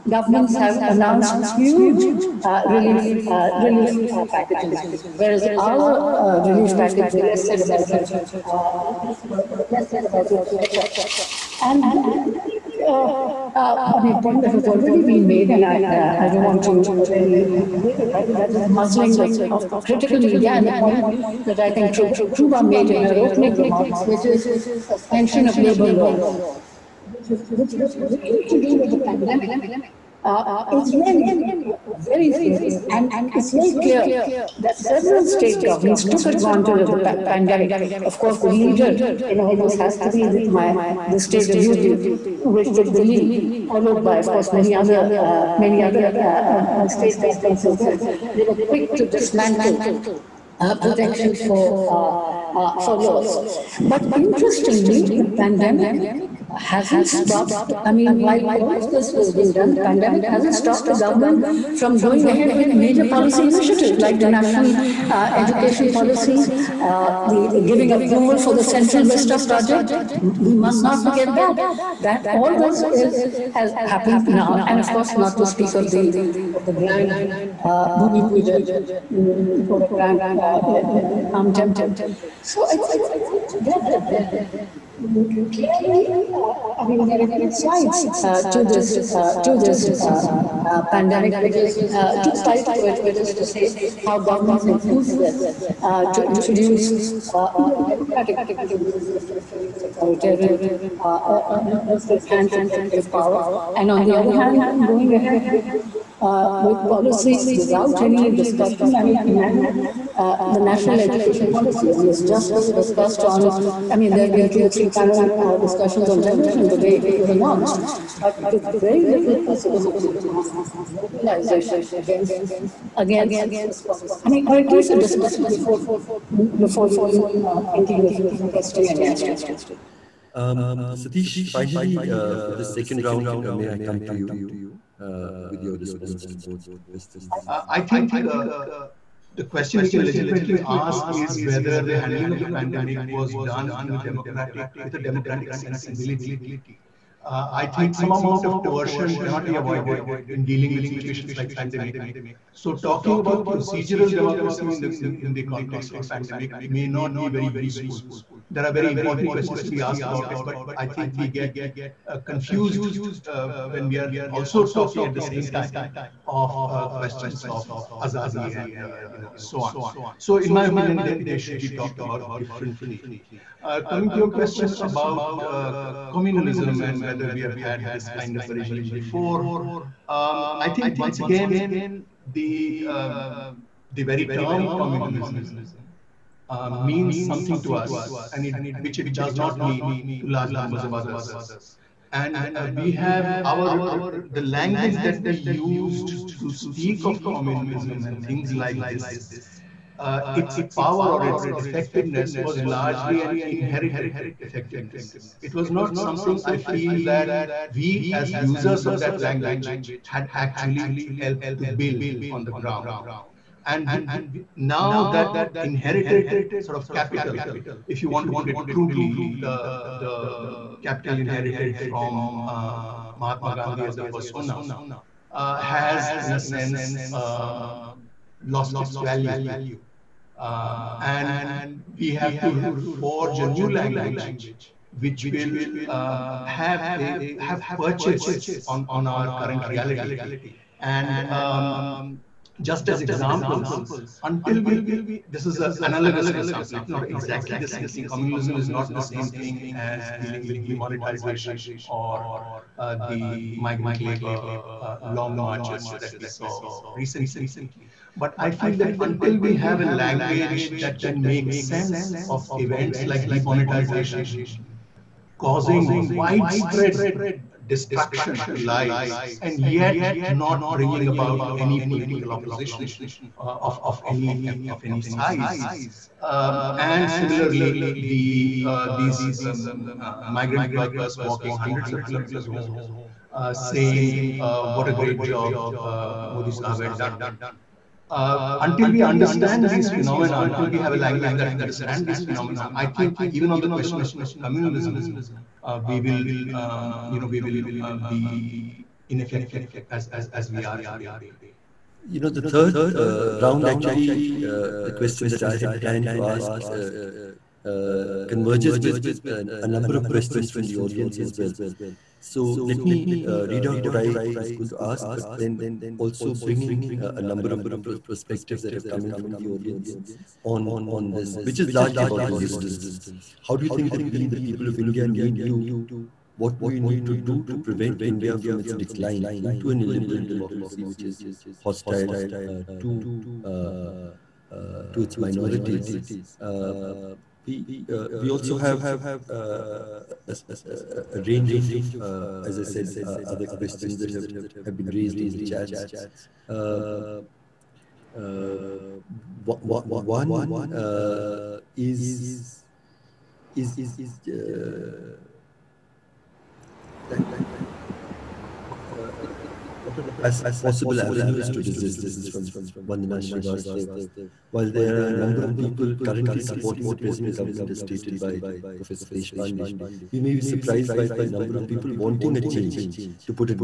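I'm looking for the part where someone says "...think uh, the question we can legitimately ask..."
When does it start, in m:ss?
2:17.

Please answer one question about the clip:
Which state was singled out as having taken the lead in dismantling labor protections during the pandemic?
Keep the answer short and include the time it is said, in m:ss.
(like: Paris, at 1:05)
UP, at 0:41.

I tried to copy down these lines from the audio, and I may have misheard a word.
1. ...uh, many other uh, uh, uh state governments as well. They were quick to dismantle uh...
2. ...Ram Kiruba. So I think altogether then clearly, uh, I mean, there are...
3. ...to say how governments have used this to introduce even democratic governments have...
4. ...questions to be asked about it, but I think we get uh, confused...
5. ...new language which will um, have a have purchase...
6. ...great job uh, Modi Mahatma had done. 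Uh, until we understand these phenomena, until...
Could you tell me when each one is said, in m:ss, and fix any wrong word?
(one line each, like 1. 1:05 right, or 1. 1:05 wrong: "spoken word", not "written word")
1. 0:45 right
2. 1:21 wrong: "Temple", not "Kiruba"
3. 1:33 right
4. 2:39 right
5. 3:53 right
6. 4:44 wrong: "Sahab", not "Mahatma".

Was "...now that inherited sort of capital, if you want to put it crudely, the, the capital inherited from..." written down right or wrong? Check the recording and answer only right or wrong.
right.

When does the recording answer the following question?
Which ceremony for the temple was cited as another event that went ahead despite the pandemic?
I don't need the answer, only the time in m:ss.
1:17.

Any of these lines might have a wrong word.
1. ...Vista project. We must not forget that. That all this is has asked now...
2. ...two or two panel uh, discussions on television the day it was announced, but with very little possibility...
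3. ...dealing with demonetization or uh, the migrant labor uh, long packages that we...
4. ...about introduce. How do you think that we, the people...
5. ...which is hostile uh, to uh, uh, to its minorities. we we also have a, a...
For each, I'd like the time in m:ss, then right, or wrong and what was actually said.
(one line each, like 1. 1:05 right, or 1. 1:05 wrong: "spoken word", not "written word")
1. 1:09 wrong: "happened", not "asked"
2. 1:54 wrong: "three", not "two"
3. 4:10 wrong: "marches", not "packages"
4. 5:22 wrong: "resistance", not "introduce"
5. 5:30 right.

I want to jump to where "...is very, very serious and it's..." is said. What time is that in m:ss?
0:30.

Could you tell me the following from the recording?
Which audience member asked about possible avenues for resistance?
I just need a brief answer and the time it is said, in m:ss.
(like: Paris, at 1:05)
Vandana Srivastav, at 6:02.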